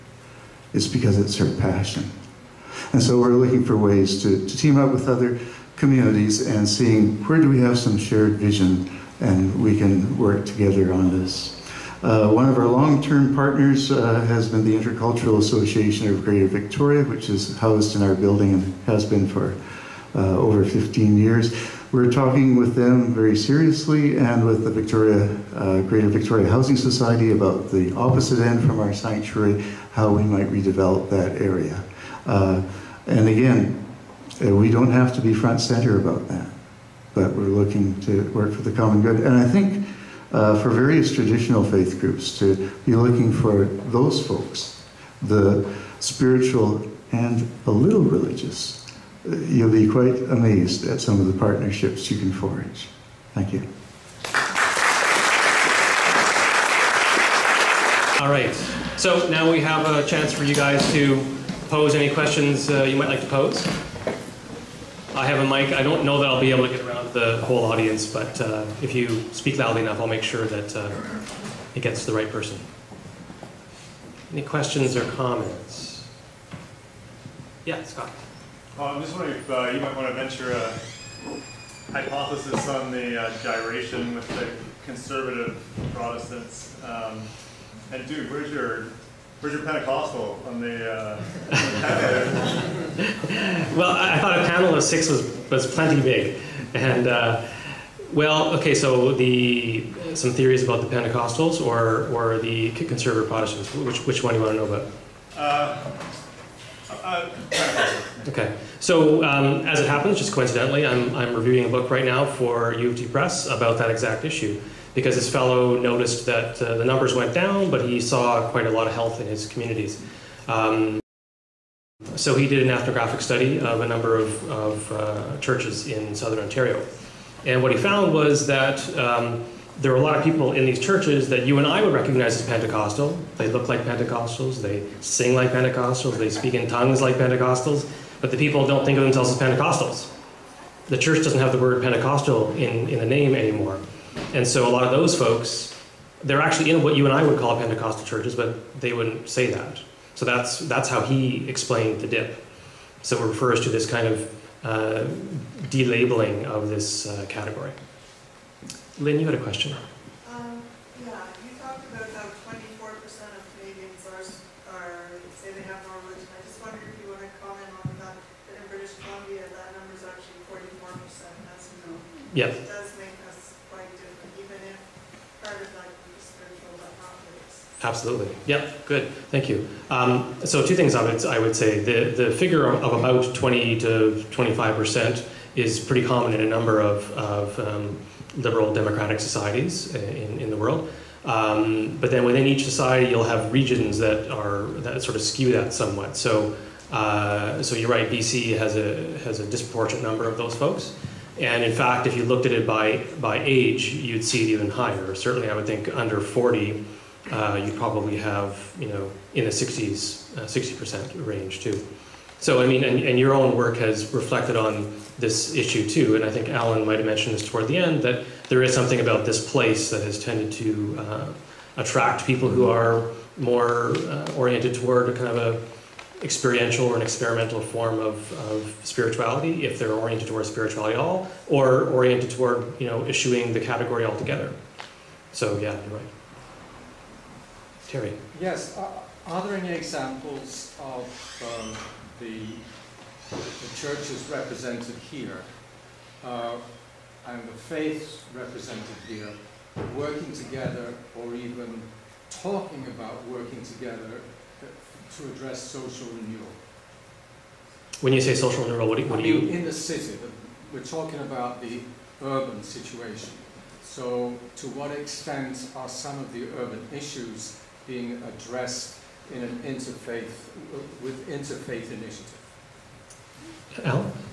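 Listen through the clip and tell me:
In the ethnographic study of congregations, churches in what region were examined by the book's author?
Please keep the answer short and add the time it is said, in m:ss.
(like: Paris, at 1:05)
Southern Ontario, at 2:06.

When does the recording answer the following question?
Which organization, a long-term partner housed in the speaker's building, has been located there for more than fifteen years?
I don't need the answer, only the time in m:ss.
0:14.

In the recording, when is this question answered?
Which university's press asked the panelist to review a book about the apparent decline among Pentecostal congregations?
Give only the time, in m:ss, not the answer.
1:52.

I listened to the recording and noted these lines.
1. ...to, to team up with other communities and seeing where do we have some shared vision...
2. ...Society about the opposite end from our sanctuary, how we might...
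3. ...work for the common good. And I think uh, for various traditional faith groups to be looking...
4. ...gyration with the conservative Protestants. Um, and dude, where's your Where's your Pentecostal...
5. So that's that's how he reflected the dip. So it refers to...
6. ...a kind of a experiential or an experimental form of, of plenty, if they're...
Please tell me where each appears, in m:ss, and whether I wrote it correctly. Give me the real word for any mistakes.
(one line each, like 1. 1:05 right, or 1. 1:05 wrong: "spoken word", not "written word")
1. 0:04 right
2. 0:26 right
3. 0:38 right
4. 1:23 right
5. 2:30 wrong: "explained", not "reflected"
6. 3:45 wrong: "spirituality", not "plenty".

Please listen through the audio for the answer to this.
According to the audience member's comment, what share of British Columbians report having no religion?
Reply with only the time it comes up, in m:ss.
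2:50.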